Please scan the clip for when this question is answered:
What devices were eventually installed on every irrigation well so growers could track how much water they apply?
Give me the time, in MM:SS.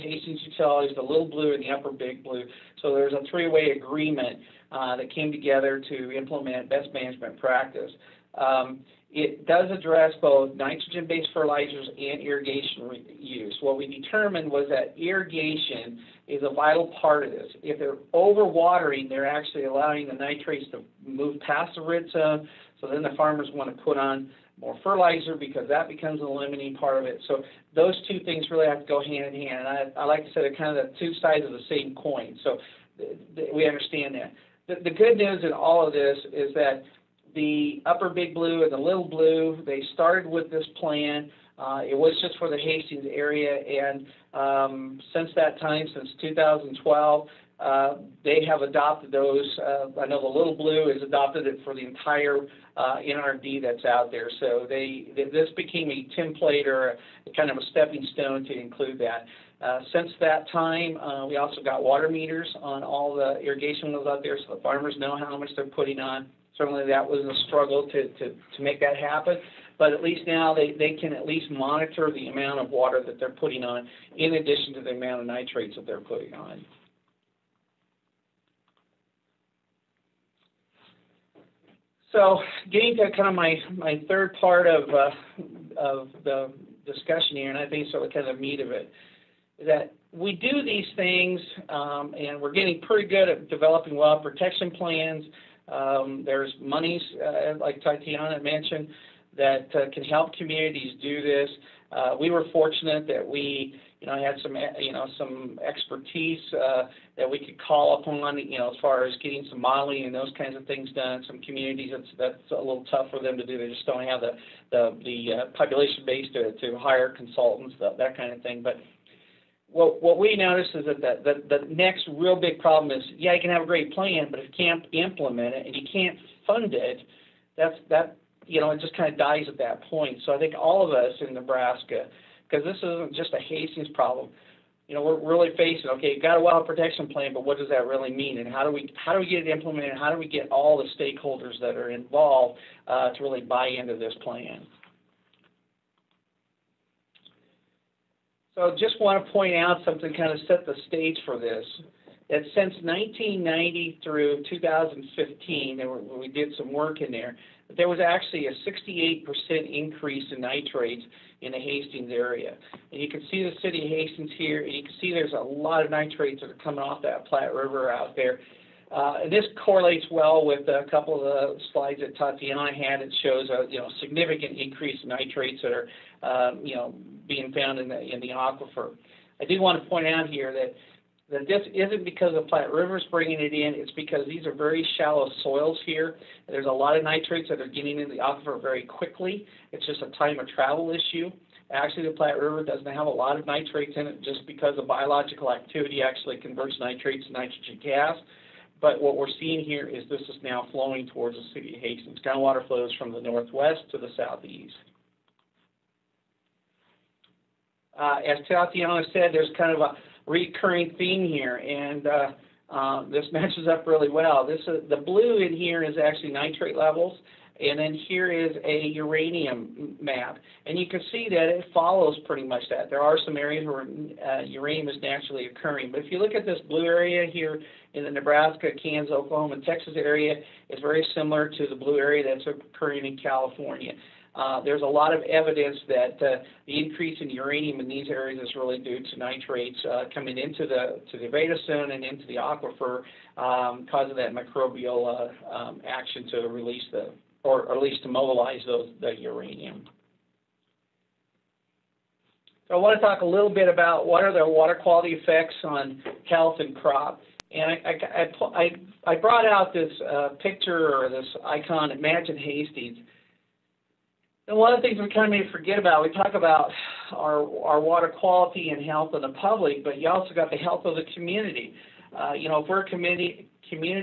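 01:01.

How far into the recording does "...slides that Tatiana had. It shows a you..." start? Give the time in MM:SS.
02:51.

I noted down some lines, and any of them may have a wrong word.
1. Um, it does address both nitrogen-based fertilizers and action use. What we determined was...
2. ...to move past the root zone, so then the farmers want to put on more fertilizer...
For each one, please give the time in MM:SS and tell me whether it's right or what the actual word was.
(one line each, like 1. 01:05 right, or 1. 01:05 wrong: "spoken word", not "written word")
1. 00:08 wrong: "irrigation", not "action"
2. 00:20 right.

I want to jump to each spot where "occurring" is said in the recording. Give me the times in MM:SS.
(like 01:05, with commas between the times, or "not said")
03:45, 03:52.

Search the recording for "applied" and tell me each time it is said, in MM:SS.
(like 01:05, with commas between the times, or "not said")
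not said.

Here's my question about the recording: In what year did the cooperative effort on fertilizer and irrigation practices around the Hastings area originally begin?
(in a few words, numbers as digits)
2012.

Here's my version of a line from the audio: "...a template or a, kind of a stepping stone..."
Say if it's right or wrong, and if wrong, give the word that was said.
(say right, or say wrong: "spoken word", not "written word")
right.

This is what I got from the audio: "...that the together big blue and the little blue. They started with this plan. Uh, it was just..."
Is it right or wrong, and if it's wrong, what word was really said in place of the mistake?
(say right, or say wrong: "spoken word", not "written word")
wrong: "upper", not "together".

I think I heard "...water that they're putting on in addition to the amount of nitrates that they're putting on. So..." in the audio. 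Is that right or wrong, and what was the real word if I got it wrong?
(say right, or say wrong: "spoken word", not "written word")
right.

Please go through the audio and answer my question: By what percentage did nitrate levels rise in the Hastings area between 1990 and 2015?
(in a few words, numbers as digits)
68%.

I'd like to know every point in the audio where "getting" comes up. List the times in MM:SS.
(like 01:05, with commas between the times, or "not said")
01:22, 01:32, 01:49, 03:07.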